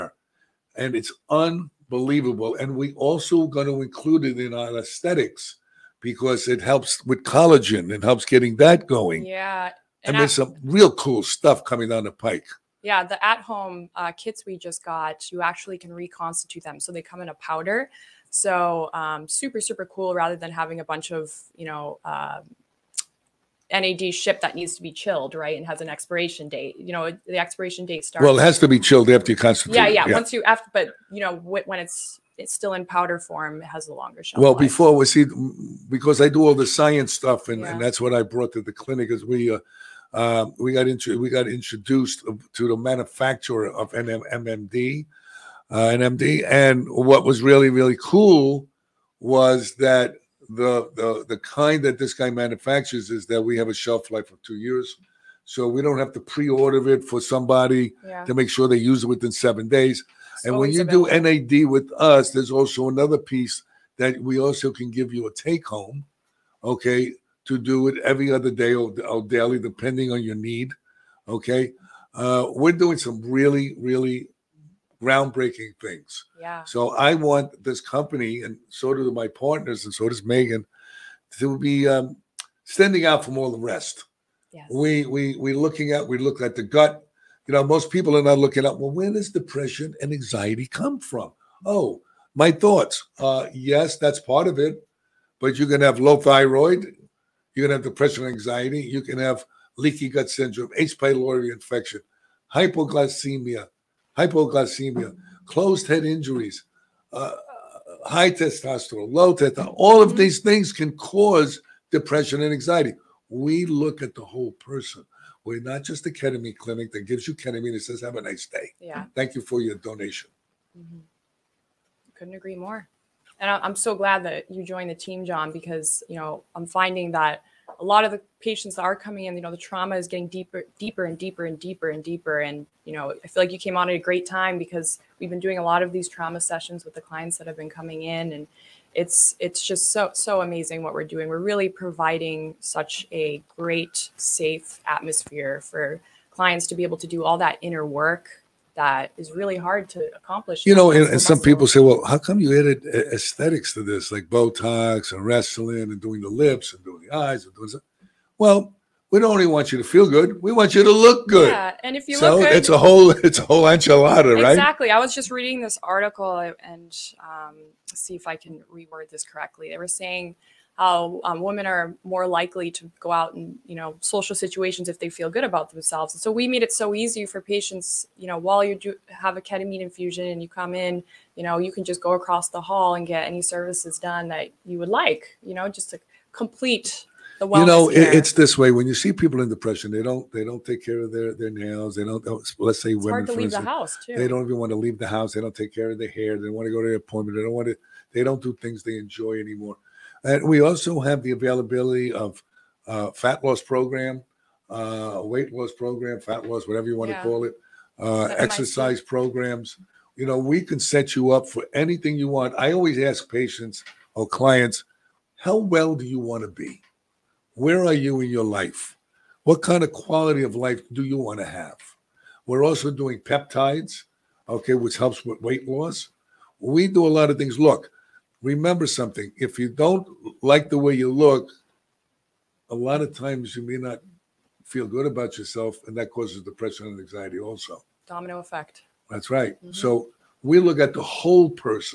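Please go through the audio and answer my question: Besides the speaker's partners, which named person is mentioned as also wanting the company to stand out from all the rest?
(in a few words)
Megan.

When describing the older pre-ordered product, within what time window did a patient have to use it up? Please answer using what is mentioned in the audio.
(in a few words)
7 days.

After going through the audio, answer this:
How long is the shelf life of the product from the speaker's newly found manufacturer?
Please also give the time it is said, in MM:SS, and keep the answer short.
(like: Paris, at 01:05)
2 years, at 00:54.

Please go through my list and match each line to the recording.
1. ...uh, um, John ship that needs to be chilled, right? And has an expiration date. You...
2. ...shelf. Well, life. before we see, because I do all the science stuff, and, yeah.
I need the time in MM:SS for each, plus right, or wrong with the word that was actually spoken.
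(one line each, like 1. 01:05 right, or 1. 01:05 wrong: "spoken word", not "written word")
1. 00:22 wrong: "NAD", not "John"
2. 00:34 right.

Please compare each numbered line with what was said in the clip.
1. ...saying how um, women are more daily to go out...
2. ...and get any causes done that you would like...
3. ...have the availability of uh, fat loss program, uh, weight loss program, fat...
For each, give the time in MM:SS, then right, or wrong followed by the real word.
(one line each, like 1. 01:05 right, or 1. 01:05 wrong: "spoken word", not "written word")
1. 02:49 wrong: "likely", not "daily"
2. 03:02 wrong: "services", not "causes"
3. 03:20 right.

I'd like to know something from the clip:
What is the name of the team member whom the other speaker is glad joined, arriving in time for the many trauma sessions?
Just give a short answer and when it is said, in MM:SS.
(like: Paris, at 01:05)
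John, at 02:05.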